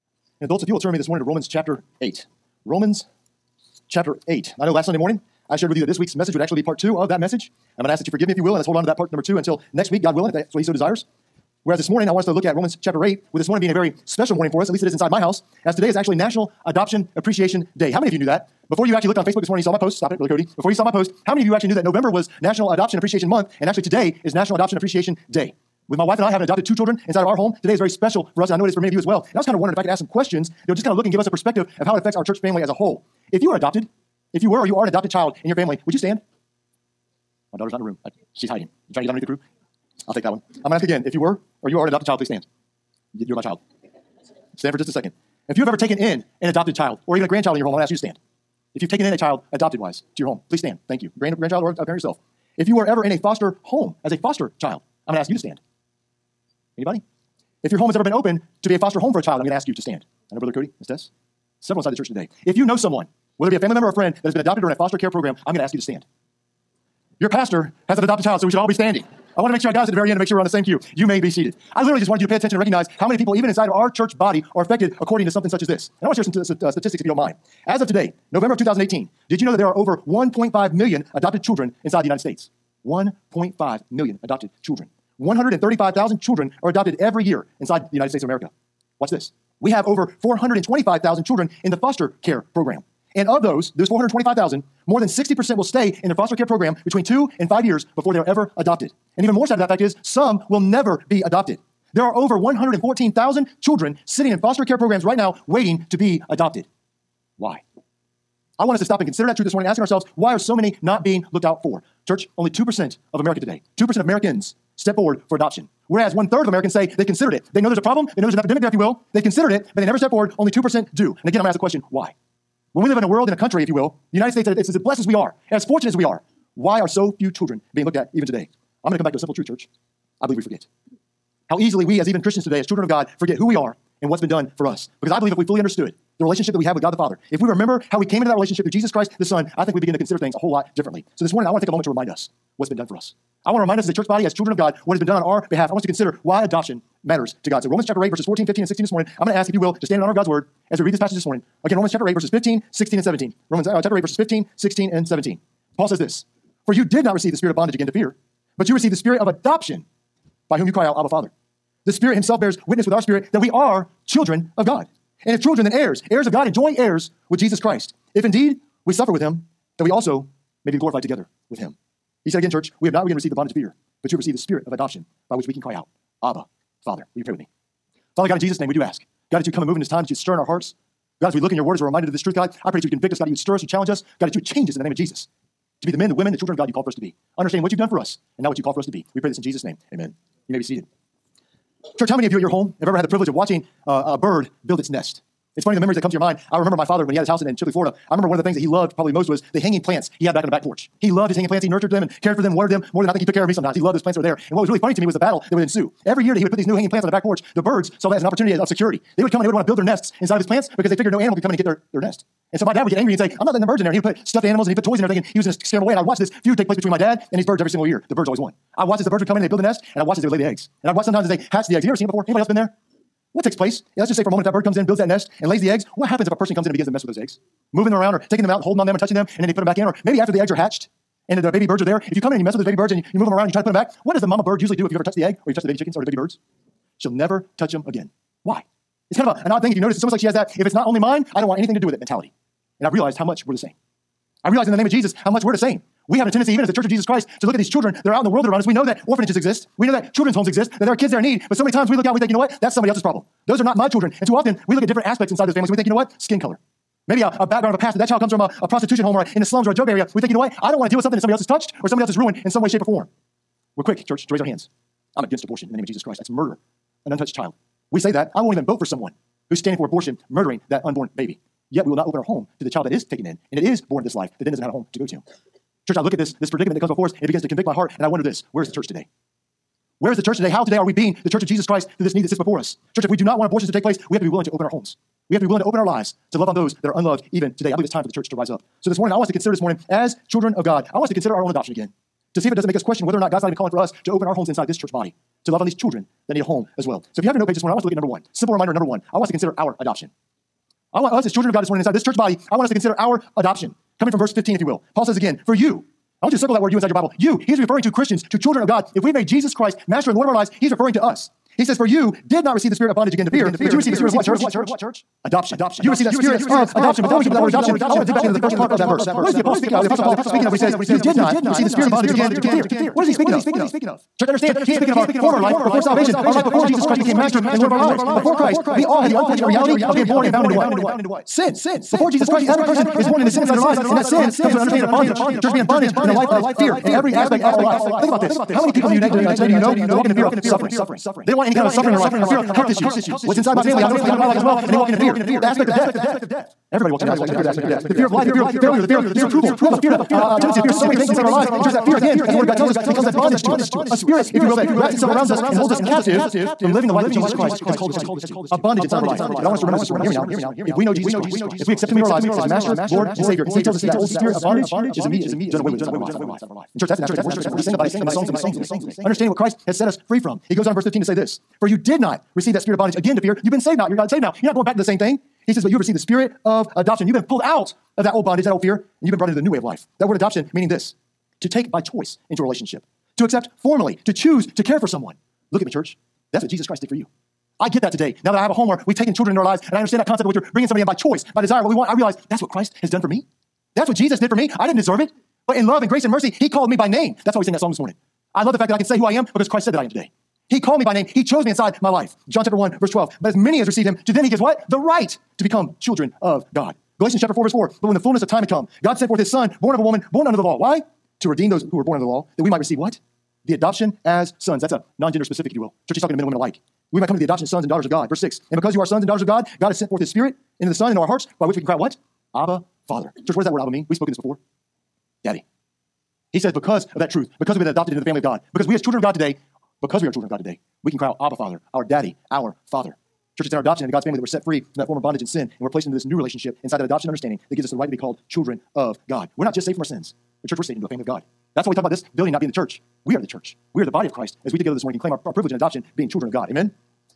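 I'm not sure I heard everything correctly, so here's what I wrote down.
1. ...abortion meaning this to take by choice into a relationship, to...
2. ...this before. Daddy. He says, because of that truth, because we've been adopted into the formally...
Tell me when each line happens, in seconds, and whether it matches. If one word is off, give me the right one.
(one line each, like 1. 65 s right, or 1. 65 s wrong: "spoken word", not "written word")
1. 380 s wrong: "adoption", not "abortion"
2. 424 s wrong: "family", not "formally".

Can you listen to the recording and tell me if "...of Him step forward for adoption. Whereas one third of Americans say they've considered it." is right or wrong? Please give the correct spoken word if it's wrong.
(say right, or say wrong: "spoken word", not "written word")
wrong: "Americans", not "Him".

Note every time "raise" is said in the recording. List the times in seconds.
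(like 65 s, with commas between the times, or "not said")
264 s.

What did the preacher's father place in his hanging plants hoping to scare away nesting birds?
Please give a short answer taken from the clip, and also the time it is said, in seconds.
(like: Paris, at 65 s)
Stuffed animals, at 214 s.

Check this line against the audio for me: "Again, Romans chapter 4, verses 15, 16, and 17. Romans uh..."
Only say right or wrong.
wrong.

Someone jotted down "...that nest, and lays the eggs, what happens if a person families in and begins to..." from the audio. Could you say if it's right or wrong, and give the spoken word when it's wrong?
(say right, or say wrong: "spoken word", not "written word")
wrong: "comes", not "families".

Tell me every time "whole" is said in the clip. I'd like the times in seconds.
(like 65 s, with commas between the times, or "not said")
32 s, 140 s.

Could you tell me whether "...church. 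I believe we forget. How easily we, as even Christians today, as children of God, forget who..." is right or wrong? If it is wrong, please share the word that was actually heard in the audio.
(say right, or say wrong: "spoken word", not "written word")
right.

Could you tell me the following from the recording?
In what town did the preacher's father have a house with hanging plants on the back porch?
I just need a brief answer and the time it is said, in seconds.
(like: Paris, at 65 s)
Chipley, Florida, at 197 s.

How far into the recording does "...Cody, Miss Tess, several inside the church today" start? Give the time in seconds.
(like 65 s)
60 s.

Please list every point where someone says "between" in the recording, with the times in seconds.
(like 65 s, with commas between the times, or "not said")
96 s, 216 s.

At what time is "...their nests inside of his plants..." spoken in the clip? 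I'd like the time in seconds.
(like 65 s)
209 s.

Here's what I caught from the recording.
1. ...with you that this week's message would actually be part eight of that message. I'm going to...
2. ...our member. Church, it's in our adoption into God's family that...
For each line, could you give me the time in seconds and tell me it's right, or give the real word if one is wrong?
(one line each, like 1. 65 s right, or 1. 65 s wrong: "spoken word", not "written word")
1. 5 s wrong: "two", not "eight"
2. 432 s wrong: "father", not "member".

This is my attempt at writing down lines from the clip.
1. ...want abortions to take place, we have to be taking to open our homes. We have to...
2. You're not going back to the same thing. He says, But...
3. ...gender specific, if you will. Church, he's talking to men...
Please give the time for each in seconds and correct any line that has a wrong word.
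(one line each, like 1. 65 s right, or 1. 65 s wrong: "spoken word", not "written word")
1. 283 s wrong: "willing", not "taking"
2. 374 s right
3. 415 s right.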